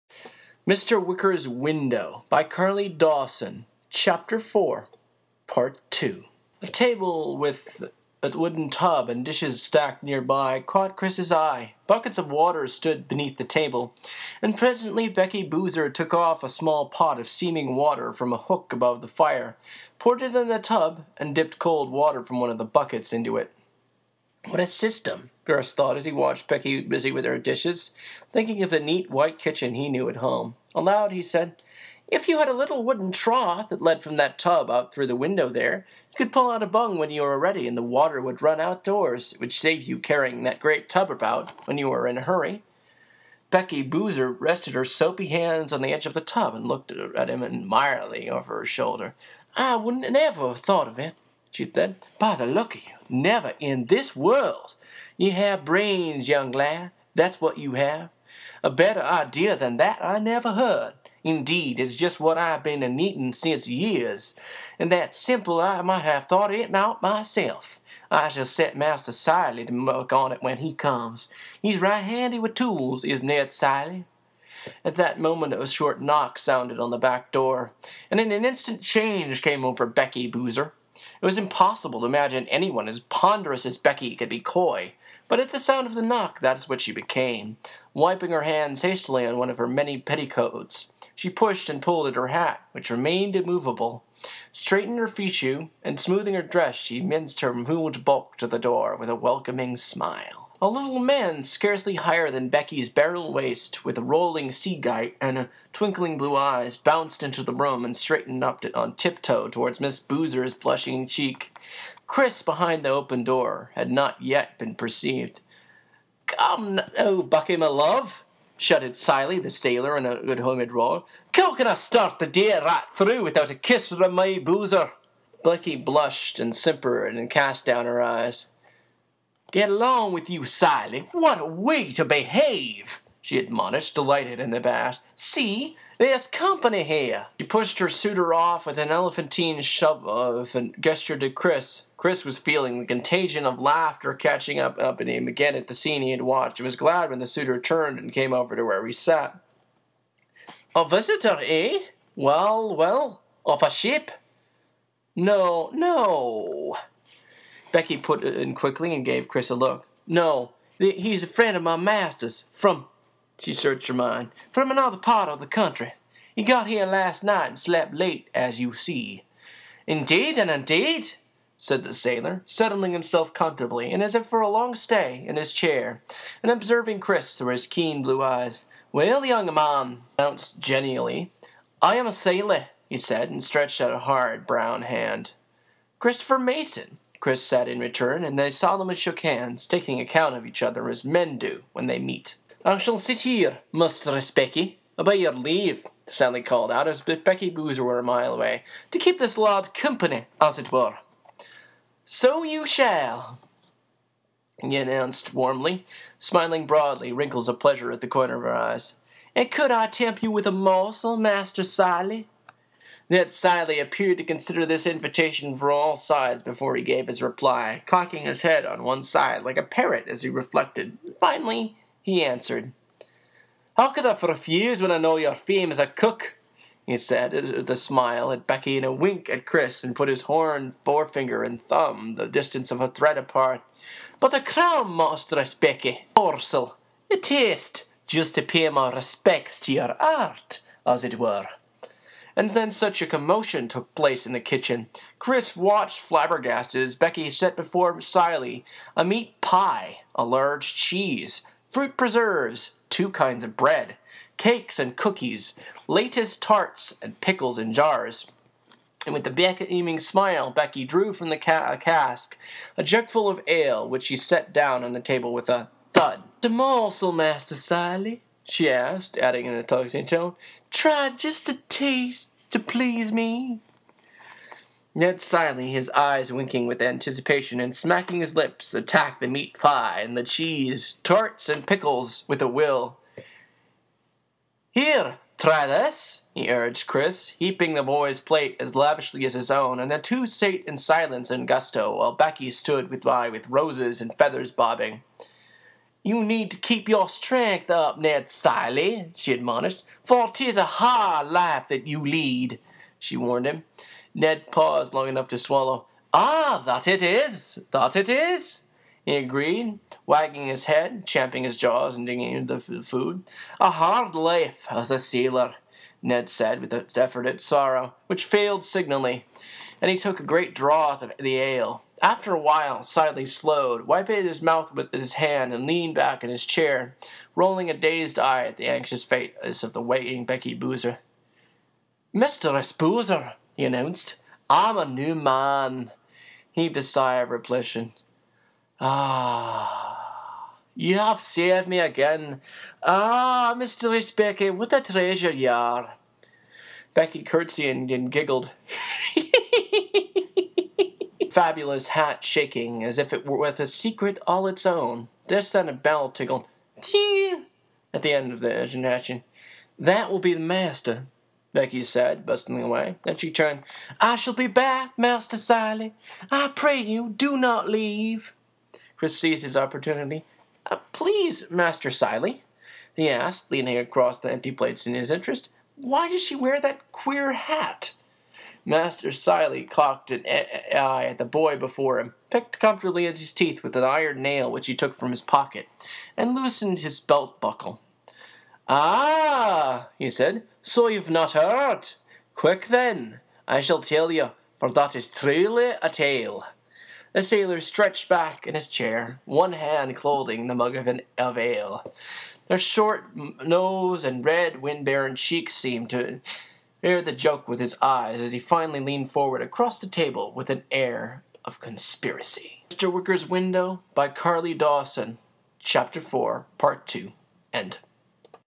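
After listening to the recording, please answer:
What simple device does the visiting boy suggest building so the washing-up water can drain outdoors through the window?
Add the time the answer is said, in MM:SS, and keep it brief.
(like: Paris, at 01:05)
a little wooden trough, at 00:32.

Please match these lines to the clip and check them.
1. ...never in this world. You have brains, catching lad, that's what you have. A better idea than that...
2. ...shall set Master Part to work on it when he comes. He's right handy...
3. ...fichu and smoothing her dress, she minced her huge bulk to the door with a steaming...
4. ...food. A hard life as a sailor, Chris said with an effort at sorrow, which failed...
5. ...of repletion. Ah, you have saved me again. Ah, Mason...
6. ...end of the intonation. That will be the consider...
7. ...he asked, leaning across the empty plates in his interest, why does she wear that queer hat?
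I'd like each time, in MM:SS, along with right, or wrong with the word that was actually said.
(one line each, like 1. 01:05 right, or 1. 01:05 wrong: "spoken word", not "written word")
1. 00:53 wrong: "young", not "catching"
2. 01:08 wrong: "Cilley", not "Part"
3. 01:35 wrong: "welcoming", not "steaming"
4. 05:12 wrong: "Ned", not "Chris"
5. 05:37 wrong: "Mistress", not "Mason"
6. 05:58 wrong: "master", not "consider"
7. 06:12 right.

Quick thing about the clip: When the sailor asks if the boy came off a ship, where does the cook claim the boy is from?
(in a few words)
another part of the country.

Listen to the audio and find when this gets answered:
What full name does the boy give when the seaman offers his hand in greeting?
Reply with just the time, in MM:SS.
03:05.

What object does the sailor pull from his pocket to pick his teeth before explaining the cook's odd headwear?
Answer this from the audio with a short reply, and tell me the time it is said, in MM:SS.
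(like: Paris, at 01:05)
an iron nail, at 06:23.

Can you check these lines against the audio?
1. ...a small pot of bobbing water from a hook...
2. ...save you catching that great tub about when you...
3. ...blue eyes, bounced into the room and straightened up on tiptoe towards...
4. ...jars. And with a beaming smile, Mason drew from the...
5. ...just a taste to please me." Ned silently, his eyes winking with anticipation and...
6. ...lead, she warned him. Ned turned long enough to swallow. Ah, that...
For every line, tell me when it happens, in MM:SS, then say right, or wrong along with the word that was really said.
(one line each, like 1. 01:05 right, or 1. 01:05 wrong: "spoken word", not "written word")
1. 00:16 wrong: "steaming", not "bobbing"
2. 00:39 wrong: "carrying", not "catching"
3. 01:46 right
4. 04:17 wrong: "Becky", not "Mason"
5. 04:31 right
6. 05:02 wrong: "paused", not "turned".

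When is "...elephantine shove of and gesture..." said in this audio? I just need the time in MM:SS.
02:18.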